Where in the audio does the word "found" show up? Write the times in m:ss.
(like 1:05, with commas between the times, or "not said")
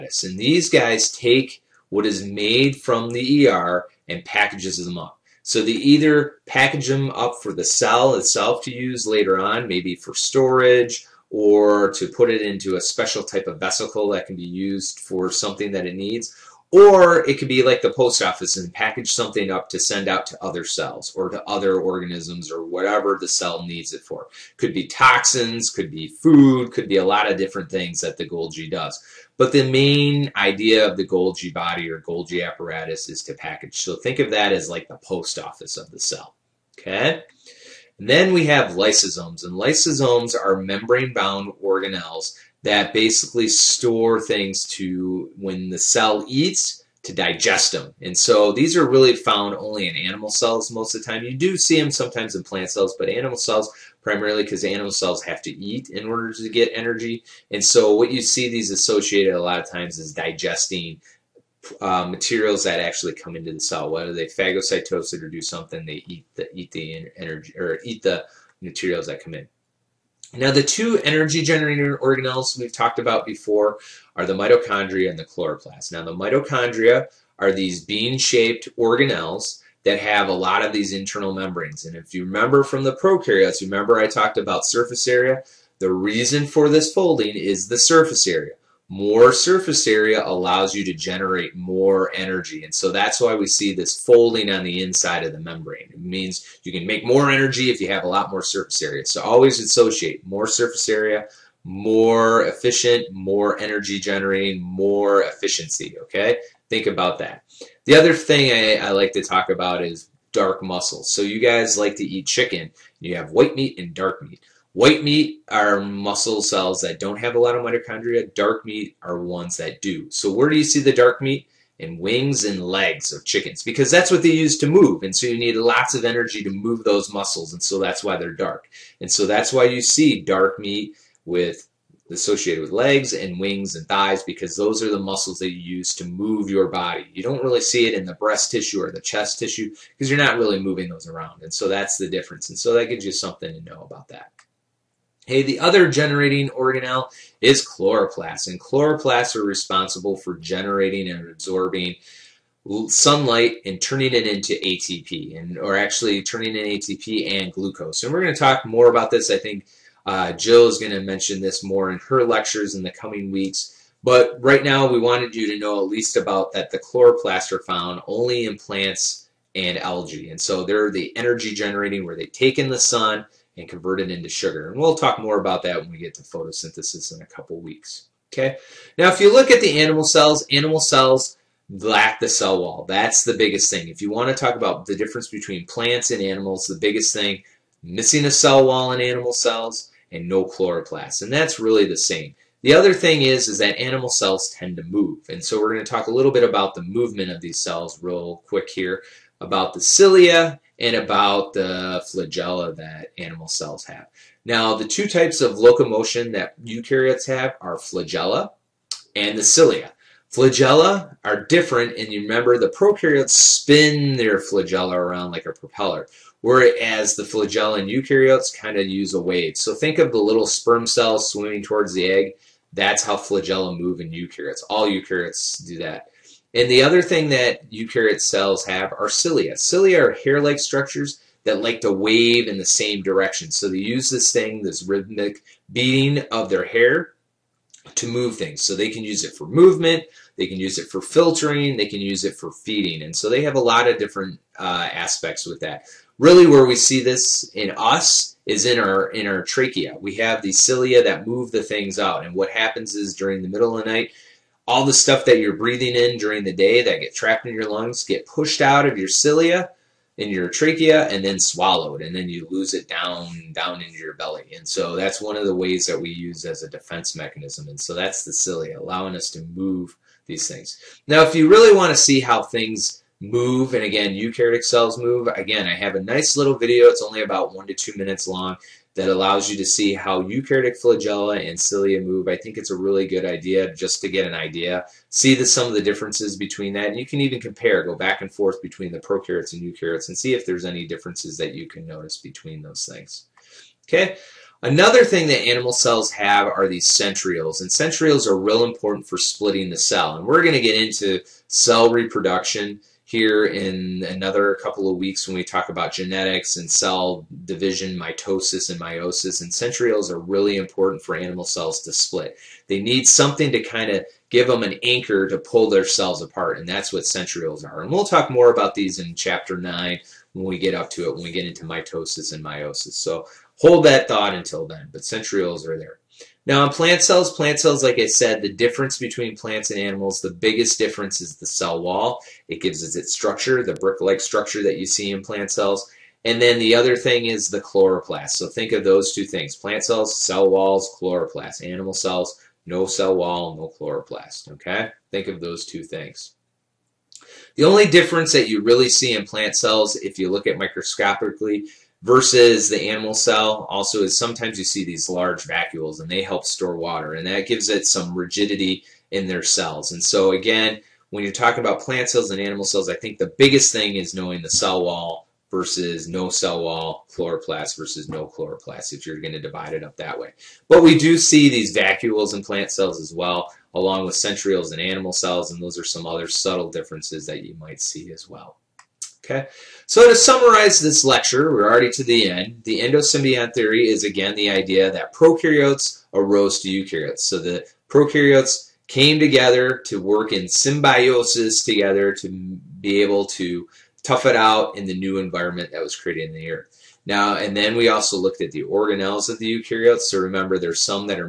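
0:49, 2:47.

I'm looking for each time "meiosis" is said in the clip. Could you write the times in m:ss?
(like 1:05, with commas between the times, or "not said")
5:08, 5:22.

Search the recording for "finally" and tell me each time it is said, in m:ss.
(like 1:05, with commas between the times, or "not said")
not said.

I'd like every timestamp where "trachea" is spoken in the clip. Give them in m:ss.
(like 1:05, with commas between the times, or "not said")
4:09, 4:20.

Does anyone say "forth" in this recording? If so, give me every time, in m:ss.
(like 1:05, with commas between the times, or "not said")
4:48.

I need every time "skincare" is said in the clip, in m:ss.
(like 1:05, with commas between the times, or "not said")
not said.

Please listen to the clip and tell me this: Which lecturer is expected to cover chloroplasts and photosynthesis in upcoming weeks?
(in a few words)
Jill.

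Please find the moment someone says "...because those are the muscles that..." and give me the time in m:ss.
2:14.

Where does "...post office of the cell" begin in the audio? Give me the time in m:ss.
0:34.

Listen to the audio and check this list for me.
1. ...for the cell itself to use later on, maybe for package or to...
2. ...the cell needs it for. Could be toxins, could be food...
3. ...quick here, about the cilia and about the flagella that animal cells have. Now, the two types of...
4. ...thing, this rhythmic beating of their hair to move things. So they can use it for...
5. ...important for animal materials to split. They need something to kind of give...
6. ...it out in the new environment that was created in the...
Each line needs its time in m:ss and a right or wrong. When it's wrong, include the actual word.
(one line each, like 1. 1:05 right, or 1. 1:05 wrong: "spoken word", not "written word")
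1. 0:07 wrong: "storage", not "package"
2. 0:23 right
3. 3:18 right
4. 3:54 right
5. 5:10 wrong: "cells", not "materials"
6. 6:34 right.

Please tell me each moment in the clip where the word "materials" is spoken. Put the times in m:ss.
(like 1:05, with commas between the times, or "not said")
1:02, 1:08.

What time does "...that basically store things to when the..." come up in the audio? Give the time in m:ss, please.
0:42.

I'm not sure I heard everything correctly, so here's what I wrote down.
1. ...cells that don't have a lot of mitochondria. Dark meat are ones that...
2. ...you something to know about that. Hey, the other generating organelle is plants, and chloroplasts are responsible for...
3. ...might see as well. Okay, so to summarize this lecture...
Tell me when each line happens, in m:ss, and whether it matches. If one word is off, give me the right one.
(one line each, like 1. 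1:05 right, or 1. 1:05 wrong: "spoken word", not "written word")
1. 1:56 right
2. 2:23 wrong: "chloroplasts", not "plants"
3. 6:17 right.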